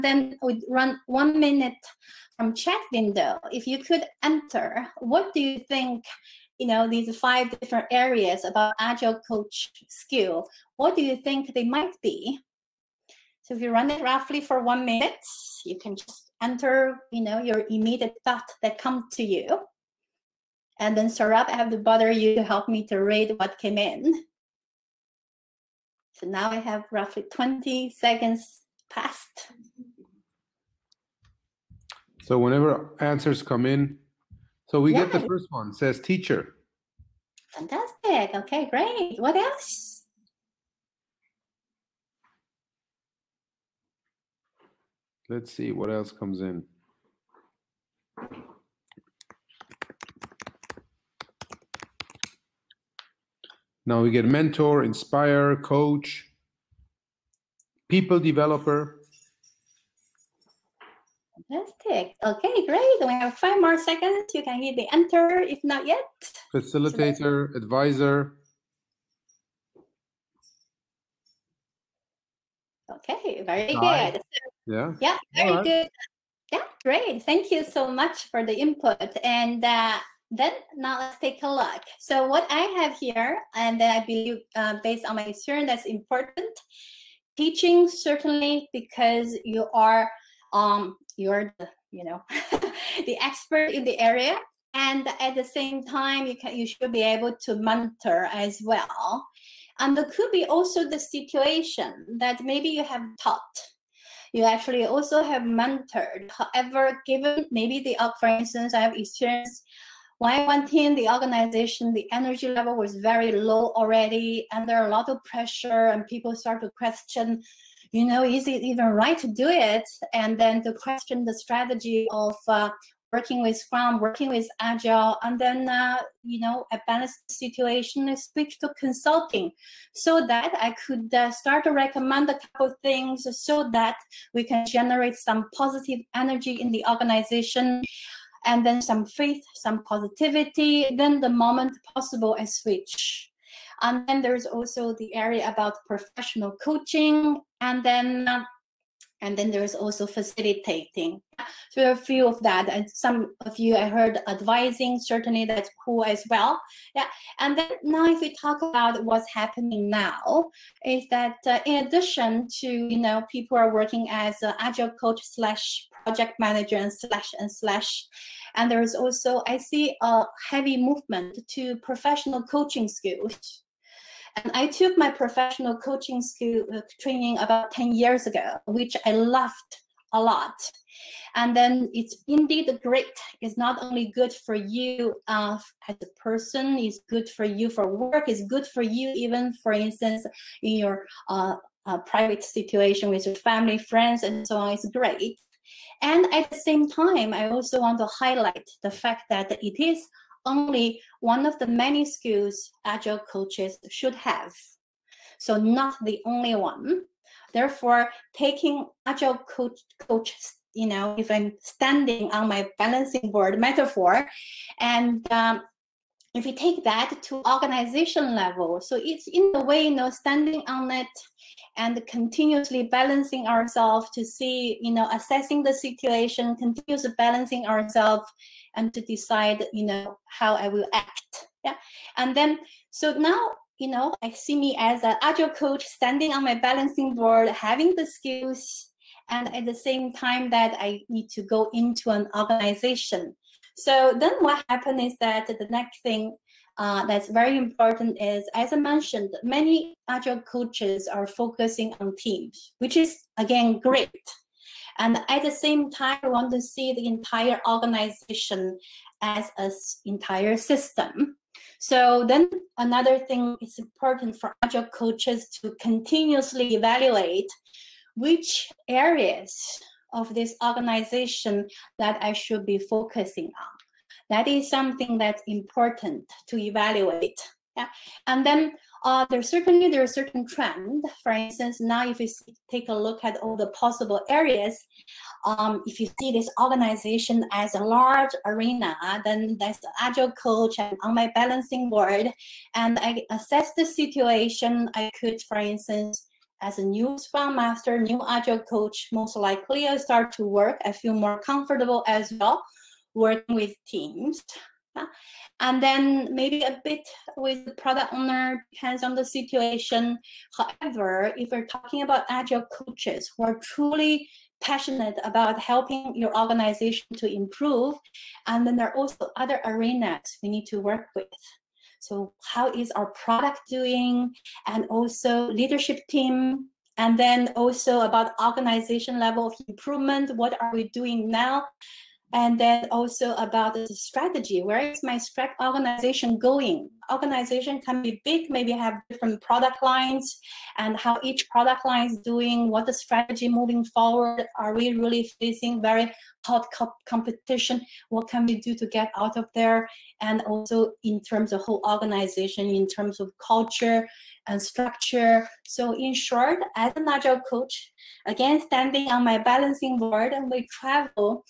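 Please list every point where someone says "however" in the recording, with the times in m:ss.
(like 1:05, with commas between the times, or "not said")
1:46, 5:10.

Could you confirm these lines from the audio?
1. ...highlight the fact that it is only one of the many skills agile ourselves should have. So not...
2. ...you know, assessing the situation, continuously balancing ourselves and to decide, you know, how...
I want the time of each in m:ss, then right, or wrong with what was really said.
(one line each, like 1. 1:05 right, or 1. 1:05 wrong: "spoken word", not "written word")
1. 3:18 wrong: "coaches", not "ourselves"
2. 3:44 right.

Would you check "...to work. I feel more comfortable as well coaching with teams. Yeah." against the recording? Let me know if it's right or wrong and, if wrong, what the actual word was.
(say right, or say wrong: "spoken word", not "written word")
wrong: "working", not "coaching".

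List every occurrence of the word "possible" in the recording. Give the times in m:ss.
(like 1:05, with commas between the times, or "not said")
2:21, 4:43.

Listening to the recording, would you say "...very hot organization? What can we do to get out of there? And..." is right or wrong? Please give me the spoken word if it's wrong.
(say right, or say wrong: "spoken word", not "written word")
wrong: "competition", not "organization".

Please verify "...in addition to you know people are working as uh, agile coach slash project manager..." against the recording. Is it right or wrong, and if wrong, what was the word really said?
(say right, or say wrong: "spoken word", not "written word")
right.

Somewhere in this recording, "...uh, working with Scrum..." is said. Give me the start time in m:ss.
2:02.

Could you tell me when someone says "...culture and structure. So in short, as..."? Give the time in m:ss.
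5:53.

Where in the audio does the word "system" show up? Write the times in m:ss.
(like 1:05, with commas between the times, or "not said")
4:20.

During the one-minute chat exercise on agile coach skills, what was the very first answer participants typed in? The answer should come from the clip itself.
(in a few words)
teacher.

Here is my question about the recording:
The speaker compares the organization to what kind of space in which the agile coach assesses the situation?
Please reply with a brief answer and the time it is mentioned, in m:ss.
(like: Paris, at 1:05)
a large arena, at 4:47.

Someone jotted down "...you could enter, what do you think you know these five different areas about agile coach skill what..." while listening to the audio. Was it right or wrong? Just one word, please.
right.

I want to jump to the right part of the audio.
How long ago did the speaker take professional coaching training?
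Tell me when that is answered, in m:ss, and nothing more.
2:57.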